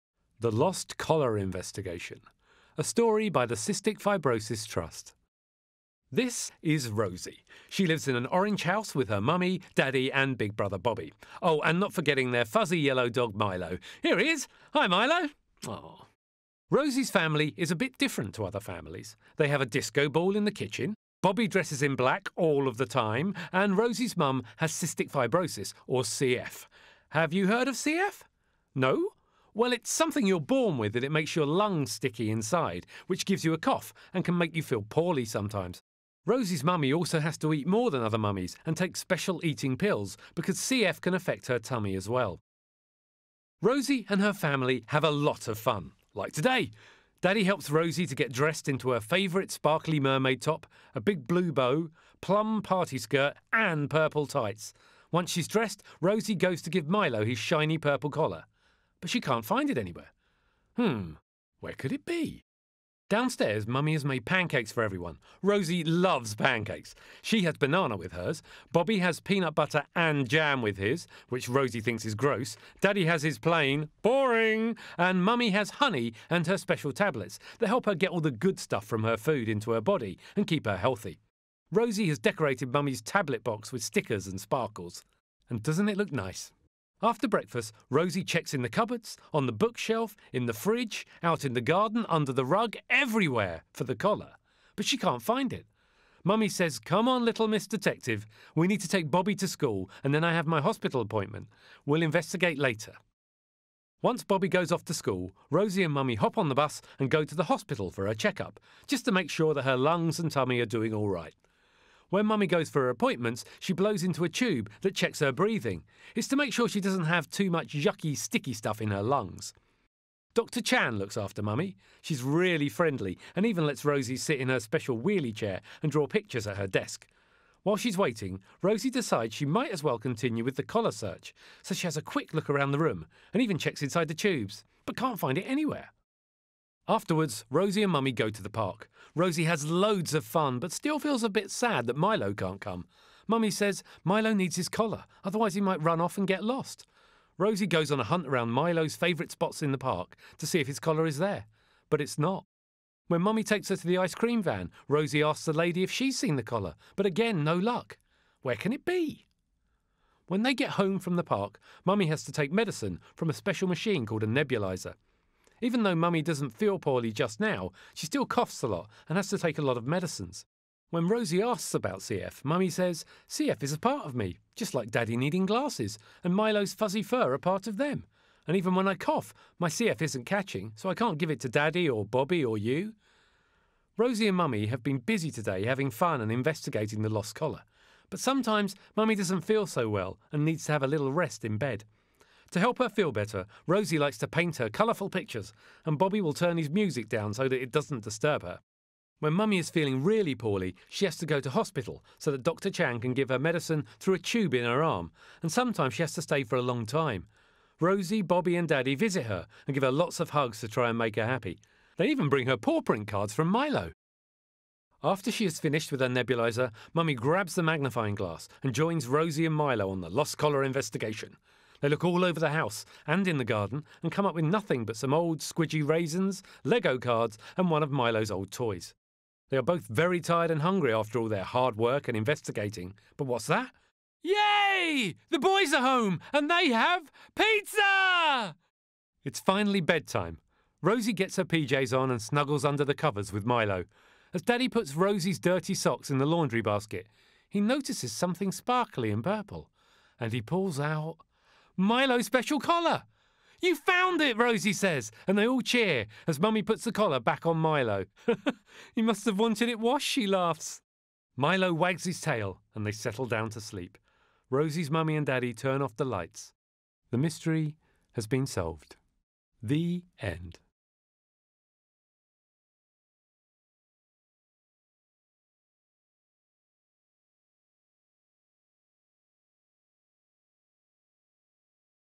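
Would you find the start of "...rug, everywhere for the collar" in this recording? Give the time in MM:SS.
01:32.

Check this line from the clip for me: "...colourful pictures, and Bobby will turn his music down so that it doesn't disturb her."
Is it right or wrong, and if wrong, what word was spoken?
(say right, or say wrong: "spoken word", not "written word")
right.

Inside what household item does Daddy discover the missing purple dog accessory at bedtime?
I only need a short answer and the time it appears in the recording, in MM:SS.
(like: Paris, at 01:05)
Laundry basket, at 04:06.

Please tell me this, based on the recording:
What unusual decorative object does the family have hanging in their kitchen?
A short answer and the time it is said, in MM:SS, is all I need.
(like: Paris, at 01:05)
Disco ball, at 00:19.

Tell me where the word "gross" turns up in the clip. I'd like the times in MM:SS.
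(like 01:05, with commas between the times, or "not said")
01:12.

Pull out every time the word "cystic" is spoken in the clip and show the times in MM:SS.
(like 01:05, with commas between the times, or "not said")
00:03, 00:24.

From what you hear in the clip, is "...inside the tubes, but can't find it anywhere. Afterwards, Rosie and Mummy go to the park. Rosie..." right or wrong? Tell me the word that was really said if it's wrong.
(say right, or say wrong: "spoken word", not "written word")
right.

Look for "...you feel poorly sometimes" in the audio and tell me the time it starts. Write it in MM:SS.
00:34.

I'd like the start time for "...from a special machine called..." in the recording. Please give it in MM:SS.
02:43.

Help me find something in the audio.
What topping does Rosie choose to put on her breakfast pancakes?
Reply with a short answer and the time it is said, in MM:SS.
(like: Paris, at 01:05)
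Banana, at 01:07.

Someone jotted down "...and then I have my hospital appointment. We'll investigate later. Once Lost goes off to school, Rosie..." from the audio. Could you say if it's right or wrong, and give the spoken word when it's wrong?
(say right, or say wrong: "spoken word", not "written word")
wrong: "Bobby", not "Lost".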